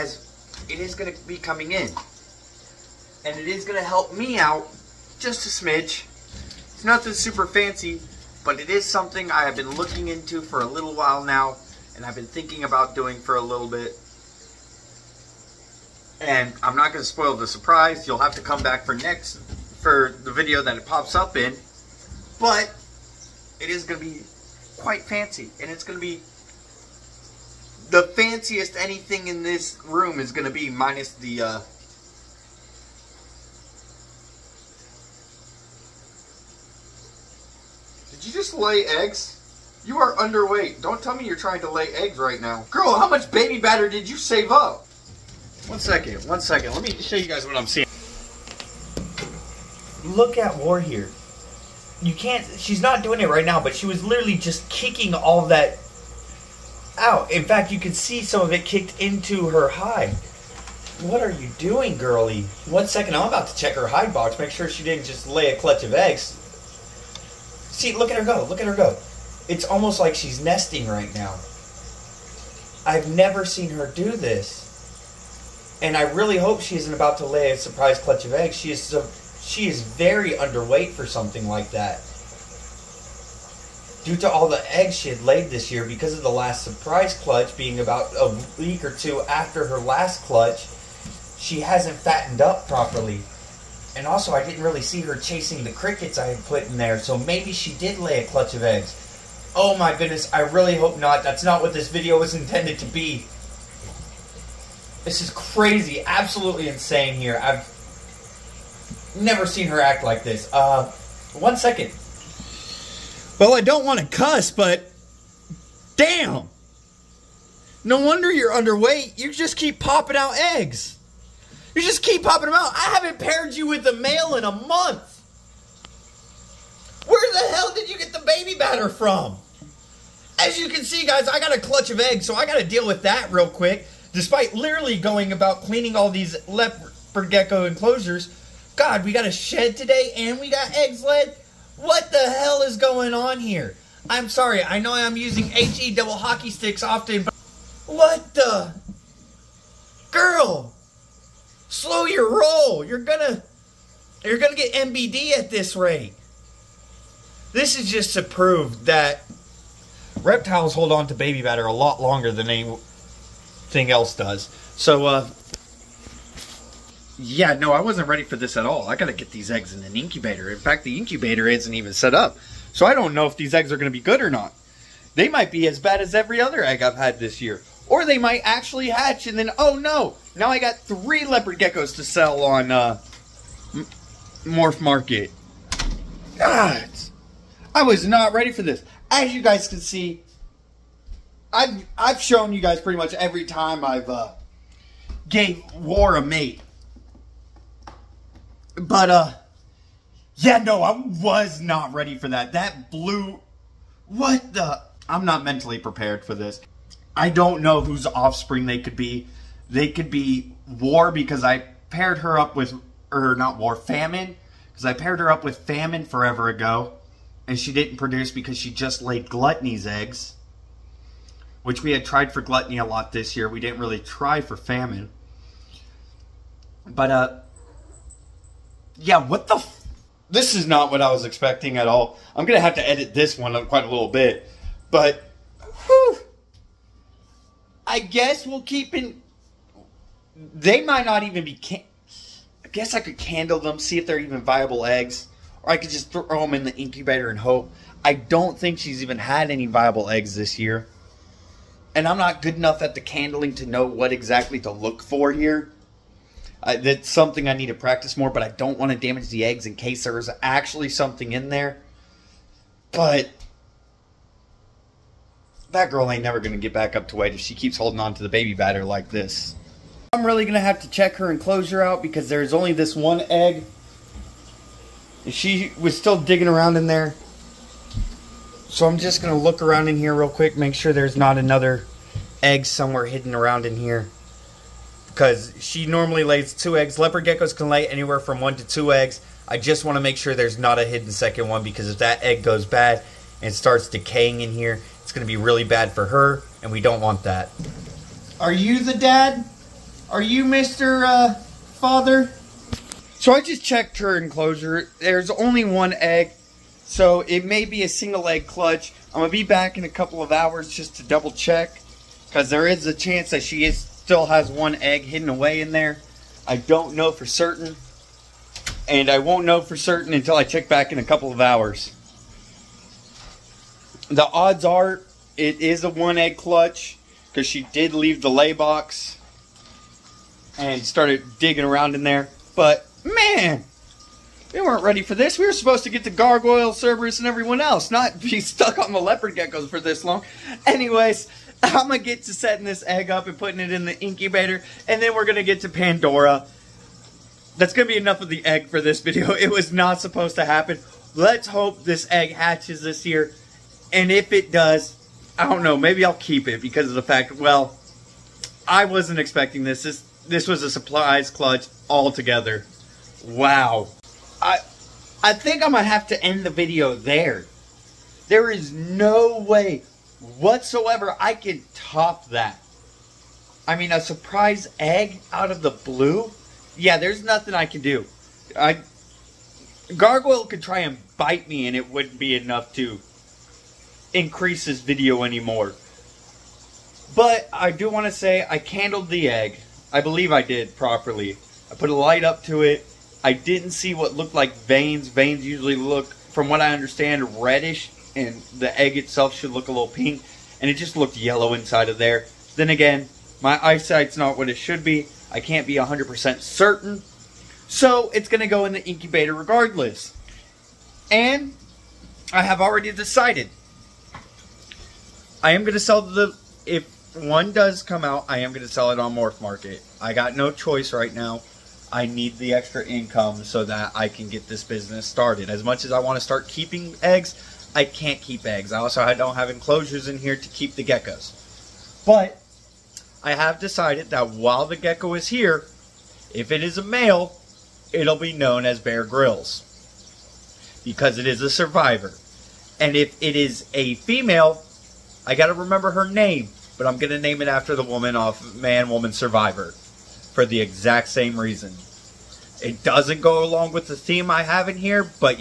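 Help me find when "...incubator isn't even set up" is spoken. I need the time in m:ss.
2:50.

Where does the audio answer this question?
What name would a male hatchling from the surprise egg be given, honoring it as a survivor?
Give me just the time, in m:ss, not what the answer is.
7:18.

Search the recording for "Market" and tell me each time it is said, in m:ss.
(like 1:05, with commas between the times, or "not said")
3:04, 6:59.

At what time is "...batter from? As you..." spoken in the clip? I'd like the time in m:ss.
2:08.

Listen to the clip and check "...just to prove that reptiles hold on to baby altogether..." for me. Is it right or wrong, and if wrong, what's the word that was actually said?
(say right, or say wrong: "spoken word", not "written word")
wrong: "batter", not "altogether".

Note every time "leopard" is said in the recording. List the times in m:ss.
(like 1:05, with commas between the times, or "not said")
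2:16, 3:01, 4:46, 5:39.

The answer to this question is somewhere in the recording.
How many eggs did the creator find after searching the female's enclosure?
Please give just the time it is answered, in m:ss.
5:05.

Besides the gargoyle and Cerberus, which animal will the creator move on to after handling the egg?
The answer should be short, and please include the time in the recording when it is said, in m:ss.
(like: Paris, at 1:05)
Pandora, at 5:45.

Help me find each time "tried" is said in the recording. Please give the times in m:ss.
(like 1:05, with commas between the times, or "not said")
3:42.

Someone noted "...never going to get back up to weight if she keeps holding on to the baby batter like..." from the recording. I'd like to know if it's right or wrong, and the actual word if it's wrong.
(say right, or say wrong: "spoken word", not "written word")
right.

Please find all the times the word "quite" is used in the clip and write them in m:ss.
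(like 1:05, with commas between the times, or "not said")
0:24, 3:53.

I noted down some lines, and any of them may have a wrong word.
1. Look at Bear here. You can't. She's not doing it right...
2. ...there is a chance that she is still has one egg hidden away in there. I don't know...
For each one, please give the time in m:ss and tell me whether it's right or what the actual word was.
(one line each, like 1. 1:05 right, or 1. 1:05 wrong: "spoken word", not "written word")
1. 0:50 wrong: "War", not "Bear"
2. 5:12 right.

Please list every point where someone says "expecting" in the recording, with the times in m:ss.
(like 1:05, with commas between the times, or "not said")
3:51, 5:59.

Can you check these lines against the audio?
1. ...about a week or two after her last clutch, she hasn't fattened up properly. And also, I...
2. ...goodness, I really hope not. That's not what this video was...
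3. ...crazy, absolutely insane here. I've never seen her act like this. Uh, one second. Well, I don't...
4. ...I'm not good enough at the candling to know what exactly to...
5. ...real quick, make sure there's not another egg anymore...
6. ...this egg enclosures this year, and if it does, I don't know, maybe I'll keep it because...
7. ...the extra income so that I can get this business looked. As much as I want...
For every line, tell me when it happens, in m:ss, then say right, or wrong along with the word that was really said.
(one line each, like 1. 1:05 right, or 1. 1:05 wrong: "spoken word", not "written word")
1. 1:27 right
2. 1:39 right
3. 1:45 right
4. 4:12 right
5. 4:40 wrong: "somewhere", not "anymore"
6. 5:51 wrong: "hatches", not "enclosures"
7. 7:02 wrong: "started", not "looked".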